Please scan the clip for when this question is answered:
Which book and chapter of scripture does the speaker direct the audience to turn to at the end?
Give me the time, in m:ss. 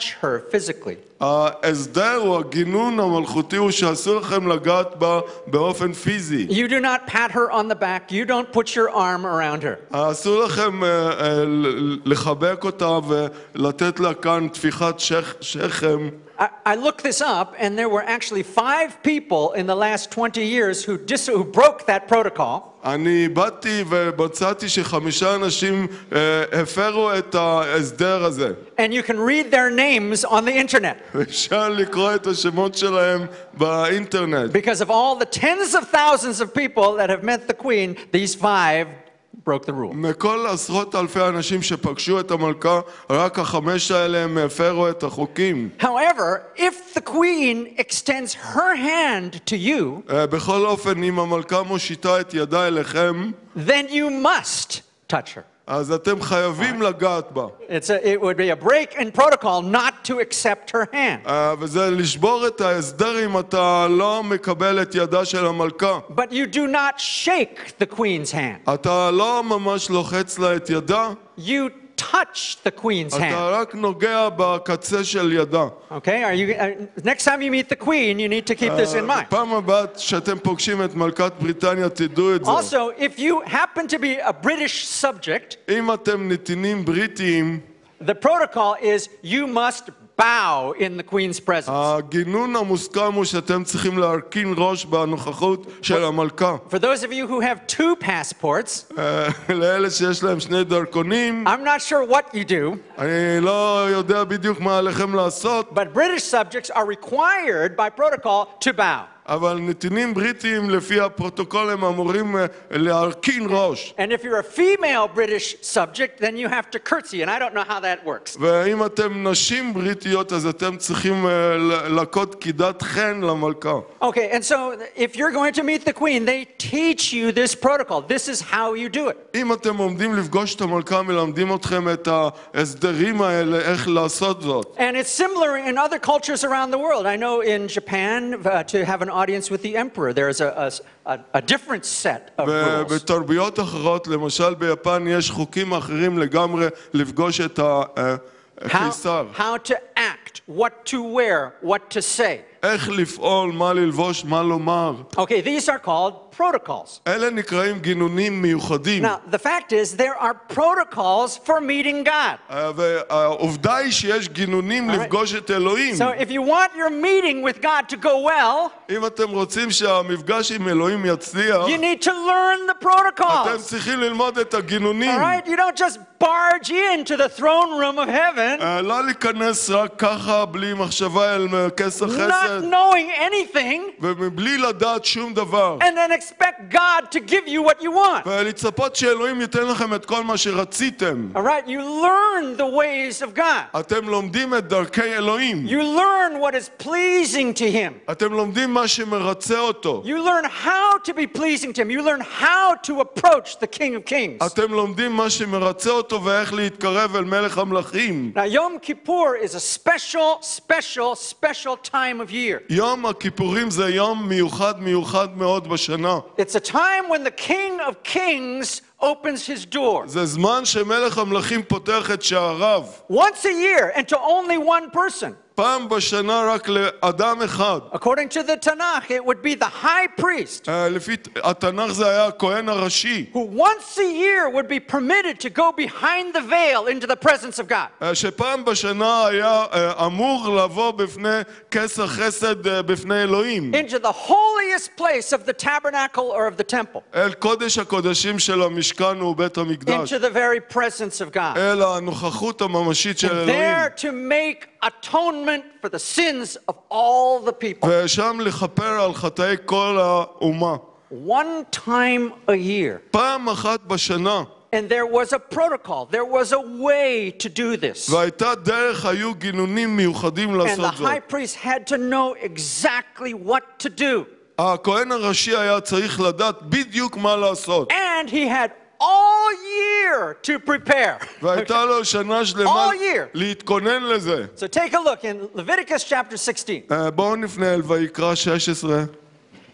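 4:45.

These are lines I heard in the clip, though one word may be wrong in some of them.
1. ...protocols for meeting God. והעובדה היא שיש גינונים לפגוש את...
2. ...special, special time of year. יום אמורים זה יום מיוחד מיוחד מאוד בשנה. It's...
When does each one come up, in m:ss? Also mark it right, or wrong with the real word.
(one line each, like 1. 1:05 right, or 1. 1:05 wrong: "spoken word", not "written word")
1. 2:40 right
2. 3:30 wrong: "הכיפורים", not "אמורים".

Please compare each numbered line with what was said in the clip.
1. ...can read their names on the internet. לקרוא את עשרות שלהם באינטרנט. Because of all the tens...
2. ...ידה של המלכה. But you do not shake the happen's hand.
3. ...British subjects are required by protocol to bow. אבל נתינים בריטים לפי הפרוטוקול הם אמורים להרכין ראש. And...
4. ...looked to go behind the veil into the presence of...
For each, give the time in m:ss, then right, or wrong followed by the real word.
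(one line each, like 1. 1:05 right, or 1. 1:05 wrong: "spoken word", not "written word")
1. 0:29 wrong: "השמות", not "עשרות"
2. 1:04 wrong: "queen", not "happen"
3. 1:45 right
4. 3:54 wrong: "permitted", not "looked".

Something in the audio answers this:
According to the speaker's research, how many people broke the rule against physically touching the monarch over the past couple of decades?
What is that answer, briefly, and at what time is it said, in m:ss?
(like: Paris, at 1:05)
5, at 0:18.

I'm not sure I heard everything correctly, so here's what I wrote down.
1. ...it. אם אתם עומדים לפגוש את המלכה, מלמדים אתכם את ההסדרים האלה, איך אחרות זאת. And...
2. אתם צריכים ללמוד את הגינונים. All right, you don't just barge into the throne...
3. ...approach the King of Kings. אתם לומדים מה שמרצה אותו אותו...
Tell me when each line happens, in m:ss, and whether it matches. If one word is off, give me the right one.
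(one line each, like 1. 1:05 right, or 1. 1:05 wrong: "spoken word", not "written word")
1. 2:09 wrong: "לעשות", not "אחרות"
2. 2:53 right
3. 3:23 right.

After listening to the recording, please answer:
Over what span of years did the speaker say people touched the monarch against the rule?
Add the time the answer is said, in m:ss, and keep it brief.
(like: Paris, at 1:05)
20 years, at 0:20.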